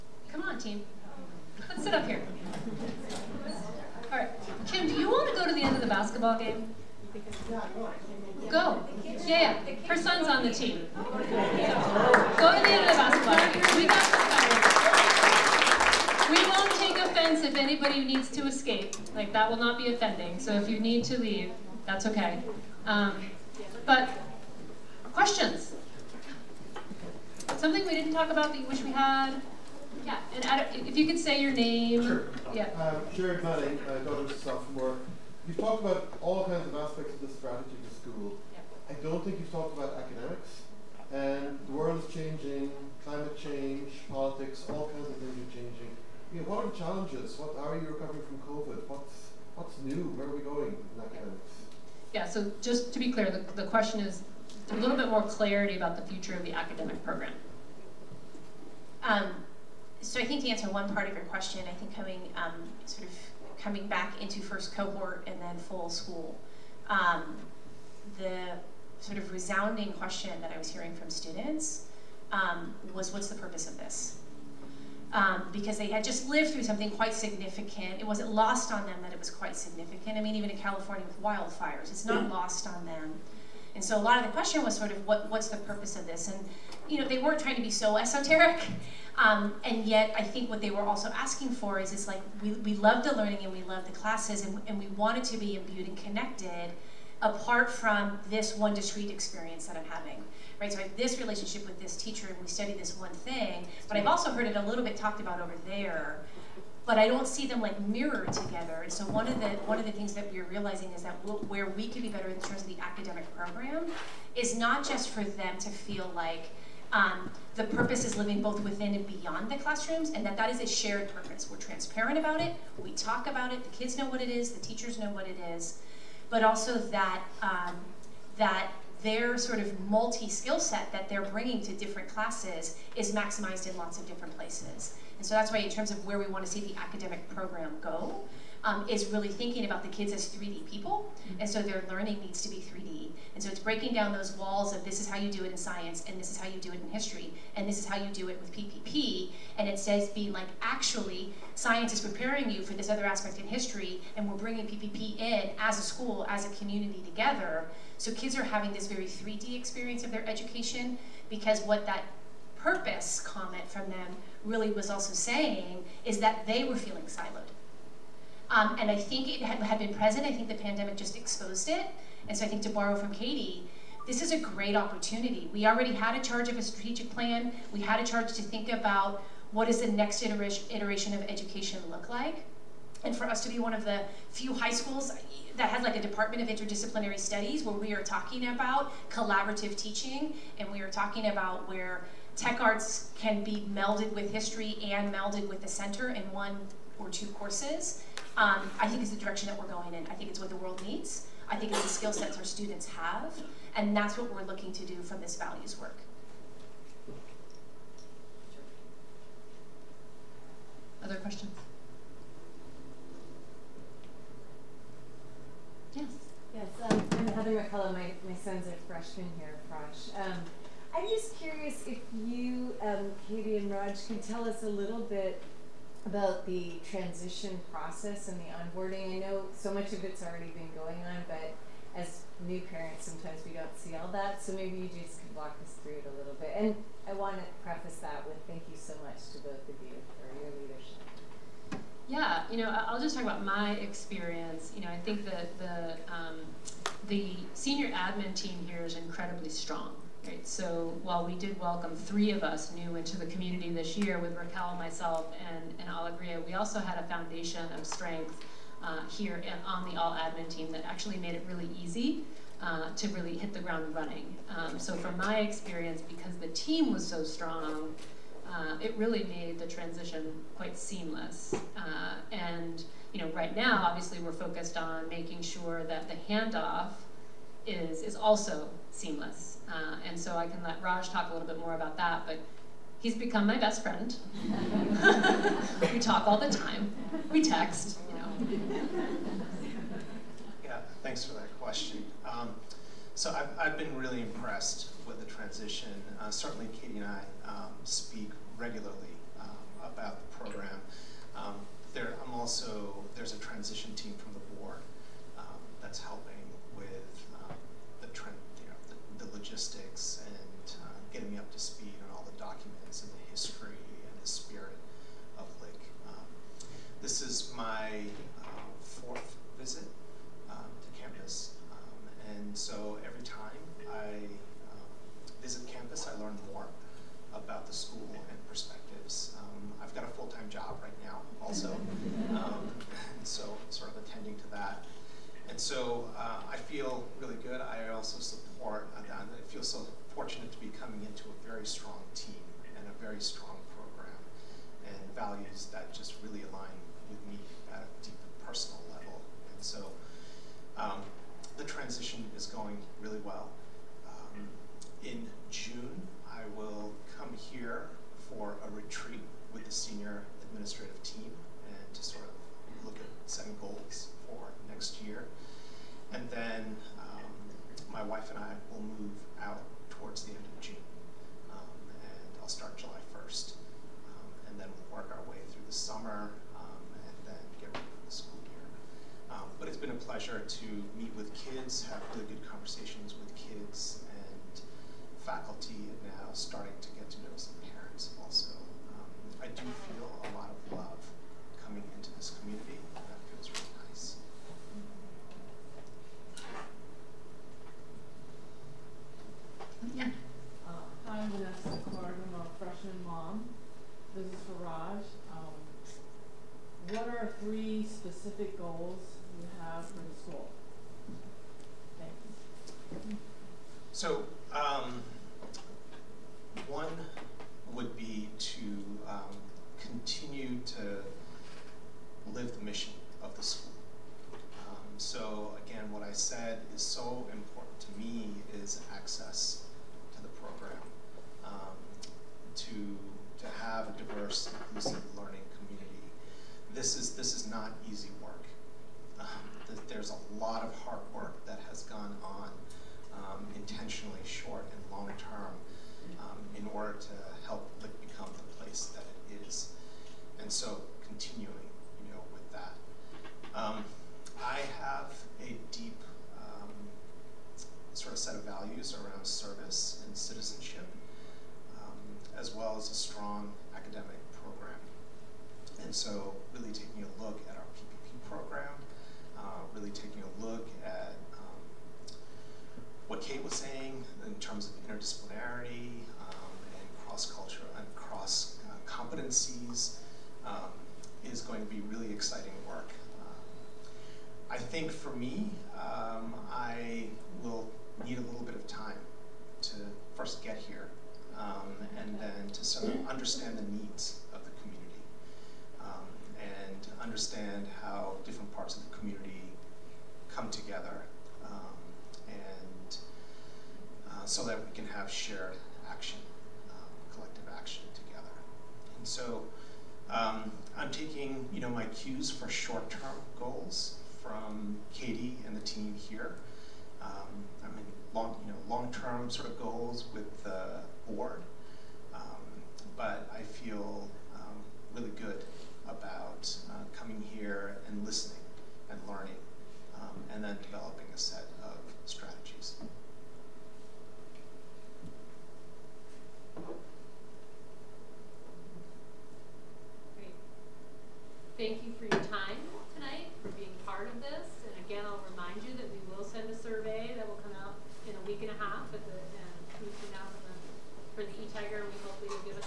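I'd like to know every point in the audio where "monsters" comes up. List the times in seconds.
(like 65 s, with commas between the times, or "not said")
not said.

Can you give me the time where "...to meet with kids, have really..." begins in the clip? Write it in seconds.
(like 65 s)
380 s.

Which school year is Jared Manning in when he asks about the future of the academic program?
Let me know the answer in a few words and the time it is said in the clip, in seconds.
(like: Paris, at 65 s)
Sophomore, at 33 s.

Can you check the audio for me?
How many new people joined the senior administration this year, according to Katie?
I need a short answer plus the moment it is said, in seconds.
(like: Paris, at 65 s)
3, at 251 s.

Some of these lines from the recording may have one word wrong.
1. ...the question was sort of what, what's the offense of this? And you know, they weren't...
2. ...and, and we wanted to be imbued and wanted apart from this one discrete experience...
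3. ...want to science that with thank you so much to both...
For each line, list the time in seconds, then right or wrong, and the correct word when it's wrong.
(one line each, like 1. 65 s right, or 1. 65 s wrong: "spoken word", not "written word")
1. 84 s wrong: "purpose", not "offense"
2. 94 s wrong: "connected", not "wanted"
3. 237 s wrong: "preface", not "science".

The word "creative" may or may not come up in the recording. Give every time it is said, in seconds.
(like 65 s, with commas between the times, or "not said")
not said.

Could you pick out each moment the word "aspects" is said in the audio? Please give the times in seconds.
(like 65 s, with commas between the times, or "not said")
36 s, 153 s.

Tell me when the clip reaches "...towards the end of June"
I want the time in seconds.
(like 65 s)
369 s.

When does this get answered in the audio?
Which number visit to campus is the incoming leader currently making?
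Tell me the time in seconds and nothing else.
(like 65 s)
318 s.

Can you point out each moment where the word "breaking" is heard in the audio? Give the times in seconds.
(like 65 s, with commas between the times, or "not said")
143 s.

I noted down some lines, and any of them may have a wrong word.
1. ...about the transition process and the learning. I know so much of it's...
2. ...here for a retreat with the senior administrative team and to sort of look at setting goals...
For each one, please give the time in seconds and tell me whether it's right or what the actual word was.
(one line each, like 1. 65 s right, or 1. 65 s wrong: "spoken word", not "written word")
1. 226 s wrong: "onboarding", not "learning"
2. 357 s right.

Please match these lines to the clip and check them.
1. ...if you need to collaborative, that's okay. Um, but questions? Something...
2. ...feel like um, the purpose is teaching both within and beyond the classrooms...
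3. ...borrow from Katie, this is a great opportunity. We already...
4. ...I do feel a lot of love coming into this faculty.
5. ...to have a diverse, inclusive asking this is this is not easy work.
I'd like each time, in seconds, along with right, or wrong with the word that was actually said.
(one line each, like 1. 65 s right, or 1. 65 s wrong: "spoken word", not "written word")
1. 20 s wrong: "leave", not "collaborative"
2. 115 s wrong: "living", not "teaching"
3. 172 s right
4. 389 s wrong: "community", not "faculty"
5. 433 s wrong: "learning", not "asking".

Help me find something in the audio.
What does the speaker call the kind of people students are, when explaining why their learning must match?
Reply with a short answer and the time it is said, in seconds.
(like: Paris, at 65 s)
3D people, at 140 s.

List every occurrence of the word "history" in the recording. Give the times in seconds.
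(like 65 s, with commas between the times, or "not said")
146 s, 153 s, 194 s, 313 s.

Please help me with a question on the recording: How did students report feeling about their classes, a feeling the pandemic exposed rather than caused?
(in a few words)
siloed.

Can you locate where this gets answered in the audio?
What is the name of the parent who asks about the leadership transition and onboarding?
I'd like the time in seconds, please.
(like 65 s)
217 s.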